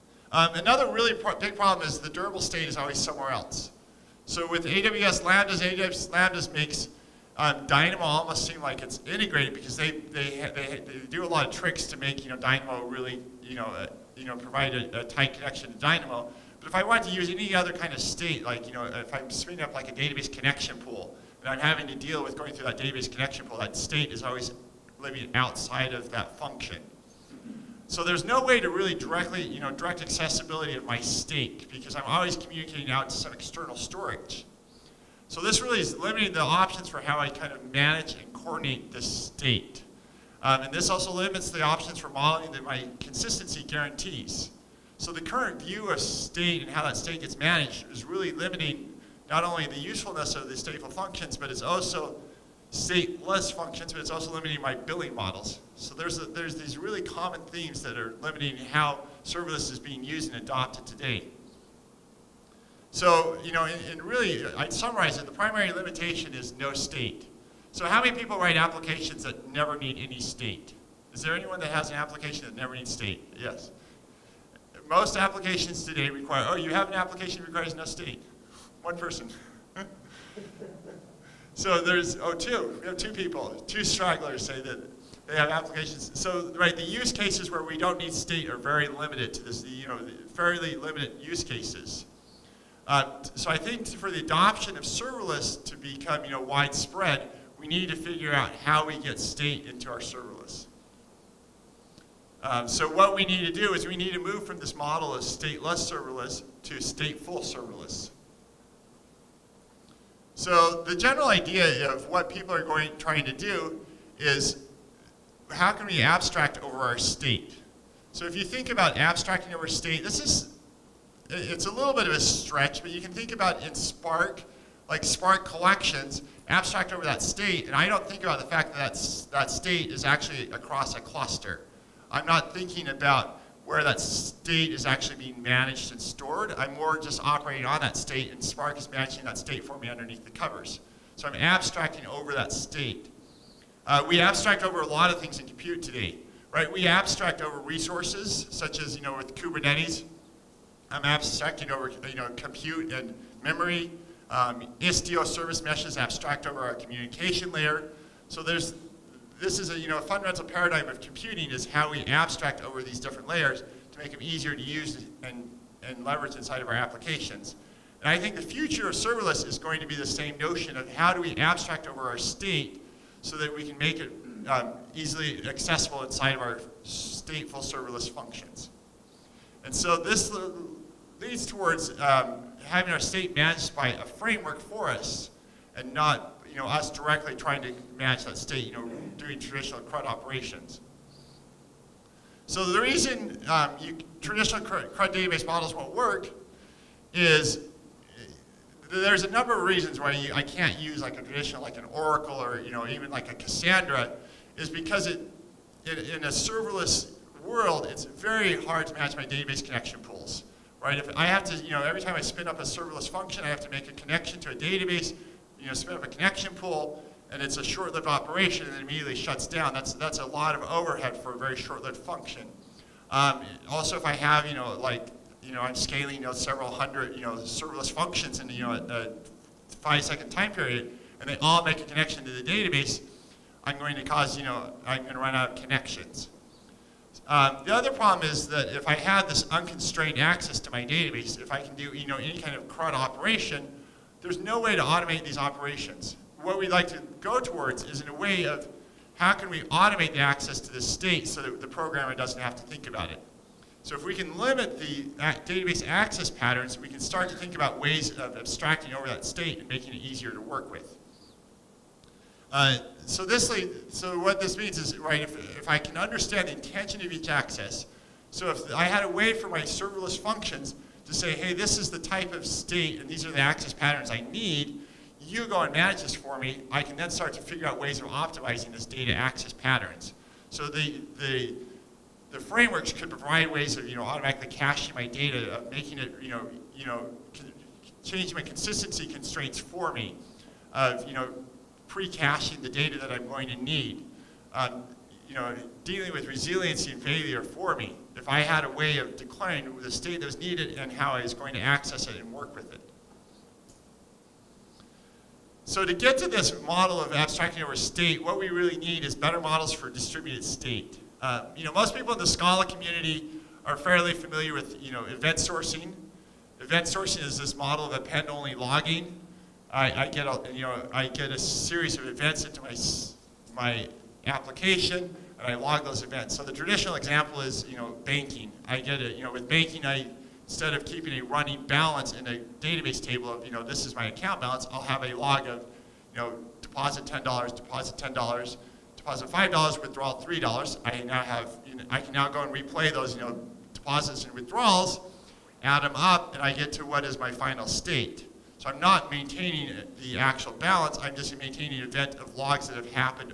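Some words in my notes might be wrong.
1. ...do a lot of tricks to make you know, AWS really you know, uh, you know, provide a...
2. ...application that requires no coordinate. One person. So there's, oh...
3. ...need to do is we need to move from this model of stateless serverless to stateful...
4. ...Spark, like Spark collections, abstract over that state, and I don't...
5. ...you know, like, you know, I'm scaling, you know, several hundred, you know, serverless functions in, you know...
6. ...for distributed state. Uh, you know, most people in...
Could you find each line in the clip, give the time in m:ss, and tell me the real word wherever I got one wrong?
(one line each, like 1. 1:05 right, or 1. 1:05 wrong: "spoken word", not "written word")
1. 0:11 wrong: "Dynamo", not "AWS"
2. 1:16 wrong: "state", not "coordinate"
3. 1:43 right
4. 2:03 right
5. 3:44 right
6. 5:09 right.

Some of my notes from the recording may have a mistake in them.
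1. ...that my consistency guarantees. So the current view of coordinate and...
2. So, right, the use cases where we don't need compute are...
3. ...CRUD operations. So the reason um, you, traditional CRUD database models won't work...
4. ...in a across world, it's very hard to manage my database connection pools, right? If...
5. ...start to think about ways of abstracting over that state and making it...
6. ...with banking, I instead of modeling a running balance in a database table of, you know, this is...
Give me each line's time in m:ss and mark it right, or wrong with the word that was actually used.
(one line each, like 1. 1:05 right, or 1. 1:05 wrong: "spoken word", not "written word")
1. 0:42 wrong: "state", not "coordinate"
2. 1:26 wrong: "state", not "compute"
3. 3:09 right
4. 3:26 wrong: "serverless", not "across"
5. 4:17 right
6. 5:29 wrong: "keeping", not "modeling".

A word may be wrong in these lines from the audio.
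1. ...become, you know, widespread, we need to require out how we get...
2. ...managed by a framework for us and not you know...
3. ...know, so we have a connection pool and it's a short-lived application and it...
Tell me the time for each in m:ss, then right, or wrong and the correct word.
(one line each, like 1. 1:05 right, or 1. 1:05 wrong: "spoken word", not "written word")
1. 1:35 wrong: "figure", not "require"
2. 3:03 right
3. 3:35 wrong: "operation", not "application".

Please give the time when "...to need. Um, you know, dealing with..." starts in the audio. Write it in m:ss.
4:53.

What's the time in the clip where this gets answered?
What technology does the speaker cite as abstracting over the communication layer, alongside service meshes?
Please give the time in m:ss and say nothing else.
2:34.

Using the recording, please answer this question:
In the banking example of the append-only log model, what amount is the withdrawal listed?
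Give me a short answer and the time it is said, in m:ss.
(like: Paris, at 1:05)
$3, at 5:39.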